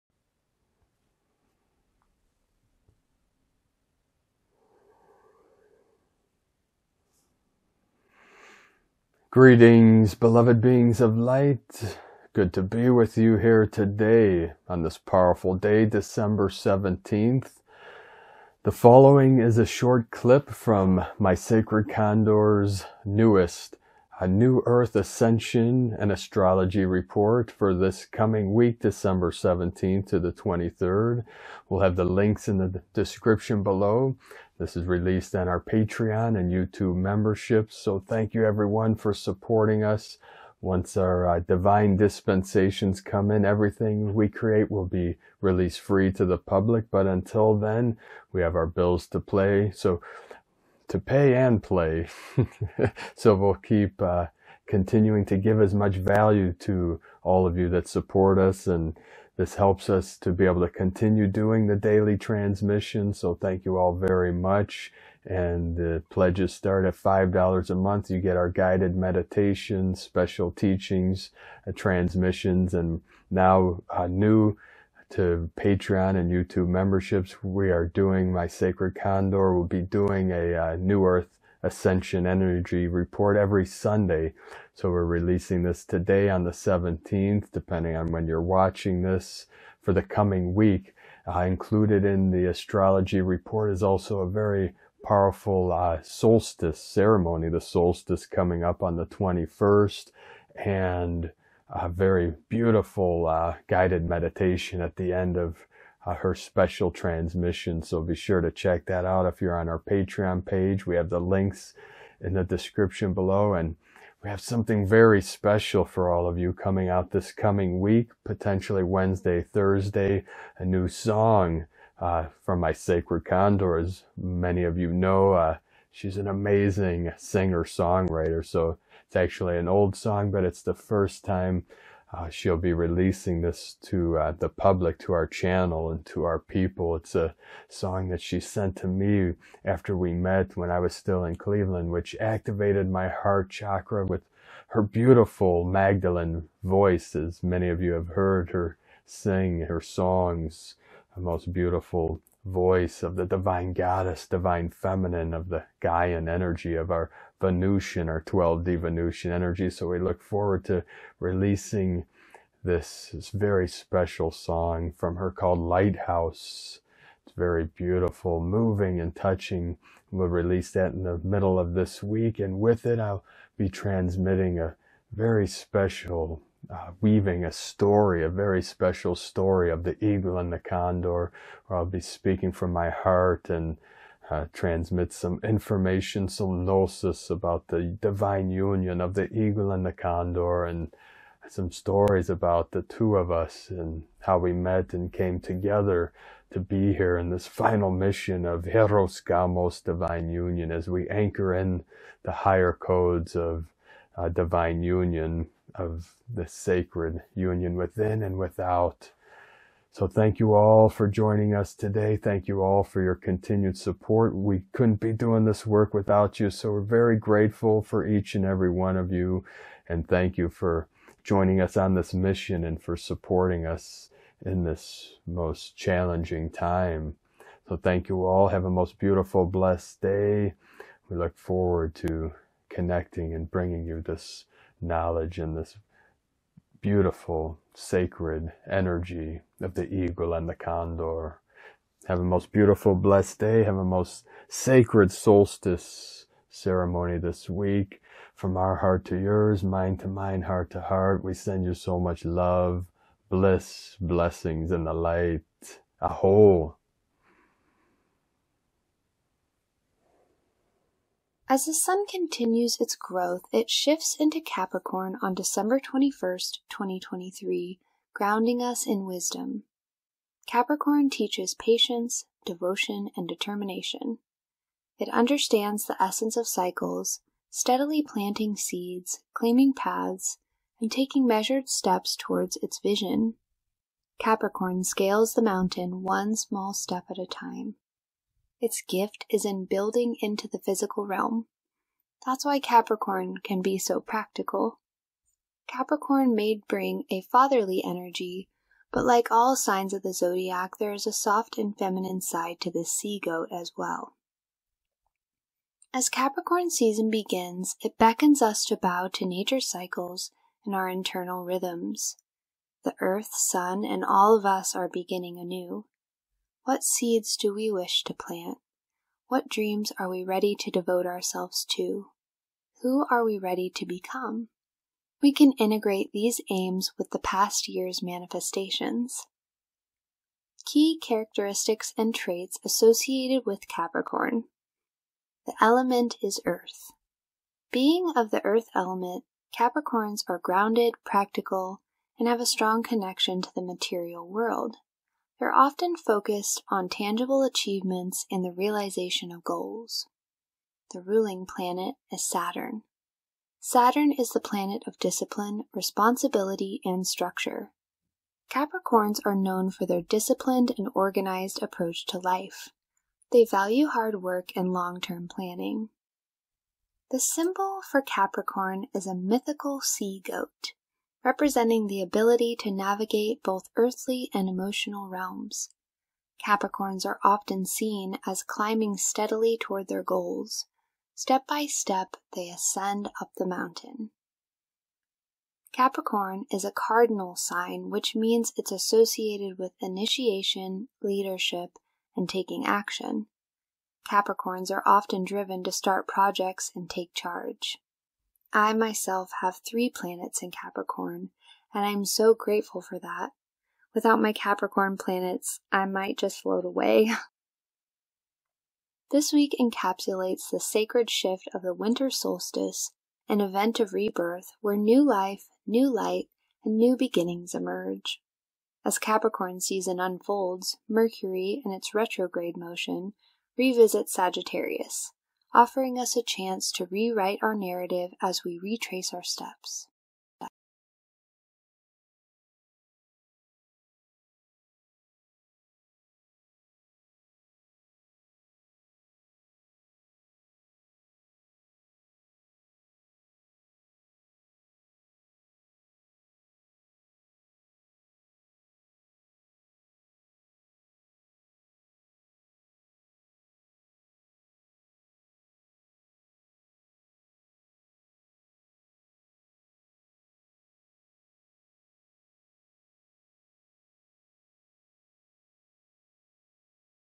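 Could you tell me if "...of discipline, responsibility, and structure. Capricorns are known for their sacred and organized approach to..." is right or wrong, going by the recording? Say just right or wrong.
wrong.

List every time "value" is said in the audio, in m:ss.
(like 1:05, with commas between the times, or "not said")
0:55, 6:03.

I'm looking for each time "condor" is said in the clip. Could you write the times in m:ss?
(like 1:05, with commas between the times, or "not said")
0:21, 1:18, 2:03, 3:00, 3:09, 4:00.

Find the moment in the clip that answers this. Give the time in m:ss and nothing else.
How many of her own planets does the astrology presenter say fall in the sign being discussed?
6:39.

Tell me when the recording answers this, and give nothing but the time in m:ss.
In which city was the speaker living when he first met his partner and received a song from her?
2:21.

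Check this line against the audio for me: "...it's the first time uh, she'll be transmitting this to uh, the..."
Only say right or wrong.
wrong.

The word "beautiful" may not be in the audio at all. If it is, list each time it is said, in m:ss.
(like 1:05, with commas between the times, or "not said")
1:42, 2:24, 2:31, 2:47, 3:48, 3:56, 4:02.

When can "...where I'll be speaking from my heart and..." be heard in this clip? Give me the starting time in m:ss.
3:01.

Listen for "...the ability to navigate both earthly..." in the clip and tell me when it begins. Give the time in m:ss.
6:11.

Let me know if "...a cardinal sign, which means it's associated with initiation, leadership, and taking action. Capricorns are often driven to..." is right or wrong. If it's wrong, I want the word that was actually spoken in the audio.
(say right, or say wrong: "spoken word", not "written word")
right.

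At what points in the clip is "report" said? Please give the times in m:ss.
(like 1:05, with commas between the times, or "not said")
0:26, 1:22, 1:33.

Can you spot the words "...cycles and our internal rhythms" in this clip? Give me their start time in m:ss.
5:09.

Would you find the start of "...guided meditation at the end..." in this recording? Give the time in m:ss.
1:43.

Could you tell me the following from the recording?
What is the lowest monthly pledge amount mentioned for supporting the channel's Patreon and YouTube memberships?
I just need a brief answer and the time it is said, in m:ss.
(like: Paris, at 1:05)
$5, at 1:06.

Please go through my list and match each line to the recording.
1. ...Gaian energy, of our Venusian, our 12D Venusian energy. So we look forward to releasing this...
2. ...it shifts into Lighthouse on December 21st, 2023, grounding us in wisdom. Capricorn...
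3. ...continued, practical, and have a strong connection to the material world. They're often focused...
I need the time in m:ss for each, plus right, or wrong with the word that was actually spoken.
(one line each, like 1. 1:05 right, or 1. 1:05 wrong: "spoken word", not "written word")
1. 2:35 right
2. 4:23 wrong: "Capricorn", not "Lighthouse"
3. 5:40 wrong: "grounded", not "continued".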